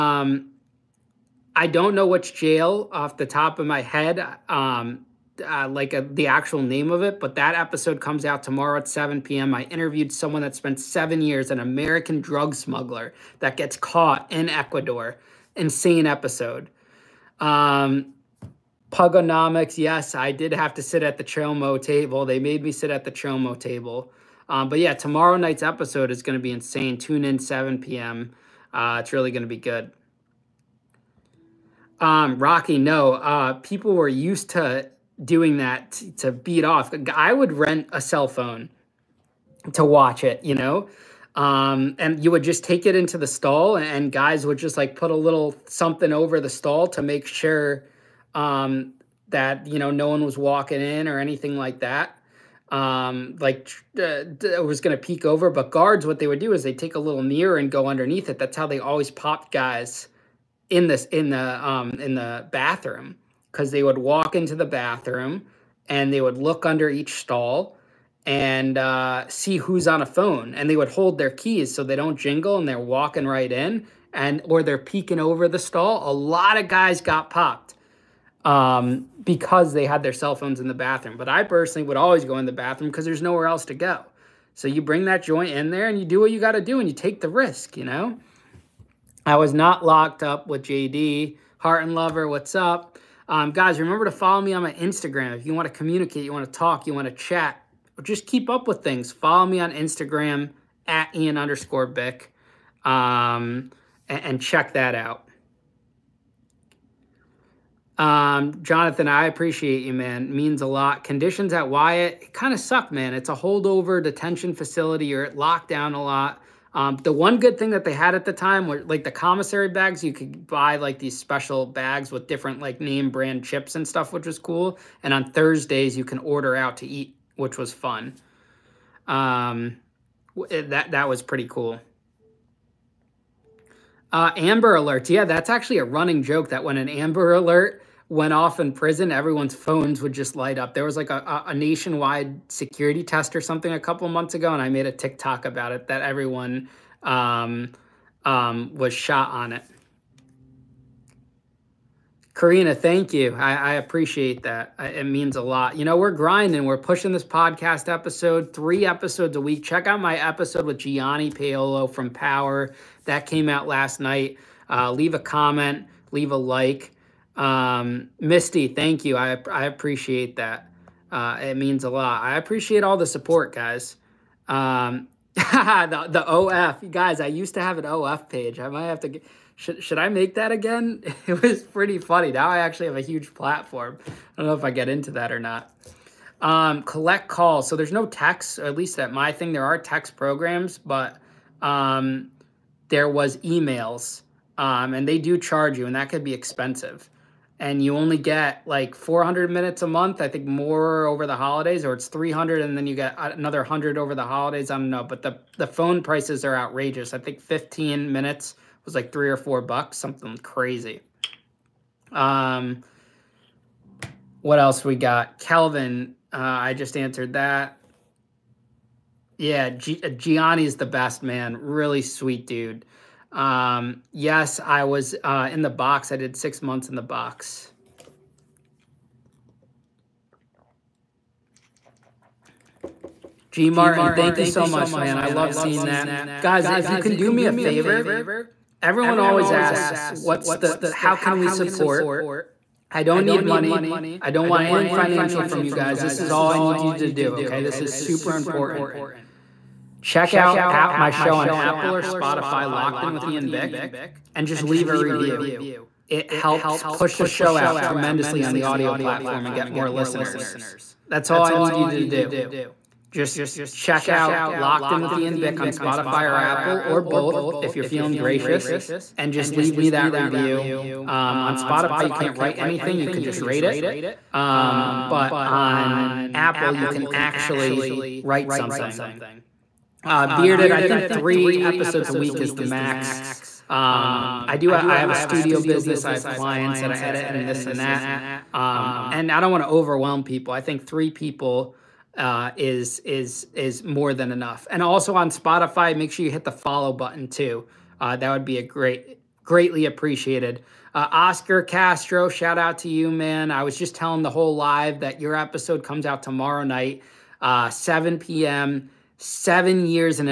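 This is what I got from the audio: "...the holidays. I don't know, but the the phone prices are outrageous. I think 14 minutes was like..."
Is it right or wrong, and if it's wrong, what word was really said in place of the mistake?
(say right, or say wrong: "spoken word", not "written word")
wrong: "15", not "14".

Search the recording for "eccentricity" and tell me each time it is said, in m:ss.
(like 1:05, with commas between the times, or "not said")
not said.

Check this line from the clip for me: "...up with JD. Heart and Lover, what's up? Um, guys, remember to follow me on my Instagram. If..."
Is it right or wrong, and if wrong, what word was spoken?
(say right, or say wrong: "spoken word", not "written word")
right.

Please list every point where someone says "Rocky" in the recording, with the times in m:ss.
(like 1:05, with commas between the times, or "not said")
0:32.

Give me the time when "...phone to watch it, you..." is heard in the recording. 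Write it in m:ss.
0:38.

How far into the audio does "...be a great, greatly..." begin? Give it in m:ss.
4:58.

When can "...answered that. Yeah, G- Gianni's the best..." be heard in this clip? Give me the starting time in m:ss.
3:36.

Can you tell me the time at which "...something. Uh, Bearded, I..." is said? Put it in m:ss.
4:38.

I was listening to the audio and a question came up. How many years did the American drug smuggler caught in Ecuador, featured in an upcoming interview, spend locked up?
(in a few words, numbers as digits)
7.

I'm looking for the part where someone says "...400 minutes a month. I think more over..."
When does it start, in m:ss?
3:18.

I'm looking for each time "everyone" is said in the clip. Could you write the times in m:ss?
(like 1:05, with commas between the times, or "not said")
2:19, 2:26, 3:58.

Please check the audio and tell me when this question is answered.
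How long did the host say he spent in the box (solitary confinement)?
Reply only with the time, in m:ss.
3:46.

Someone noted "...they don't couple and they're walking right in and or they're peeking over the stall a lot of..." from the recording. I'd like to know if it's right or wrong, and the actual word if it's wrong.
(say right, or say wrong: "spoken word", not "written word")
wrong: "jingle", not "couple".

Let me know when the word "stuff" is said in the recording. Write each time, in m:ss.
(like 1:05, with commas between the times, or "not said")
2:03.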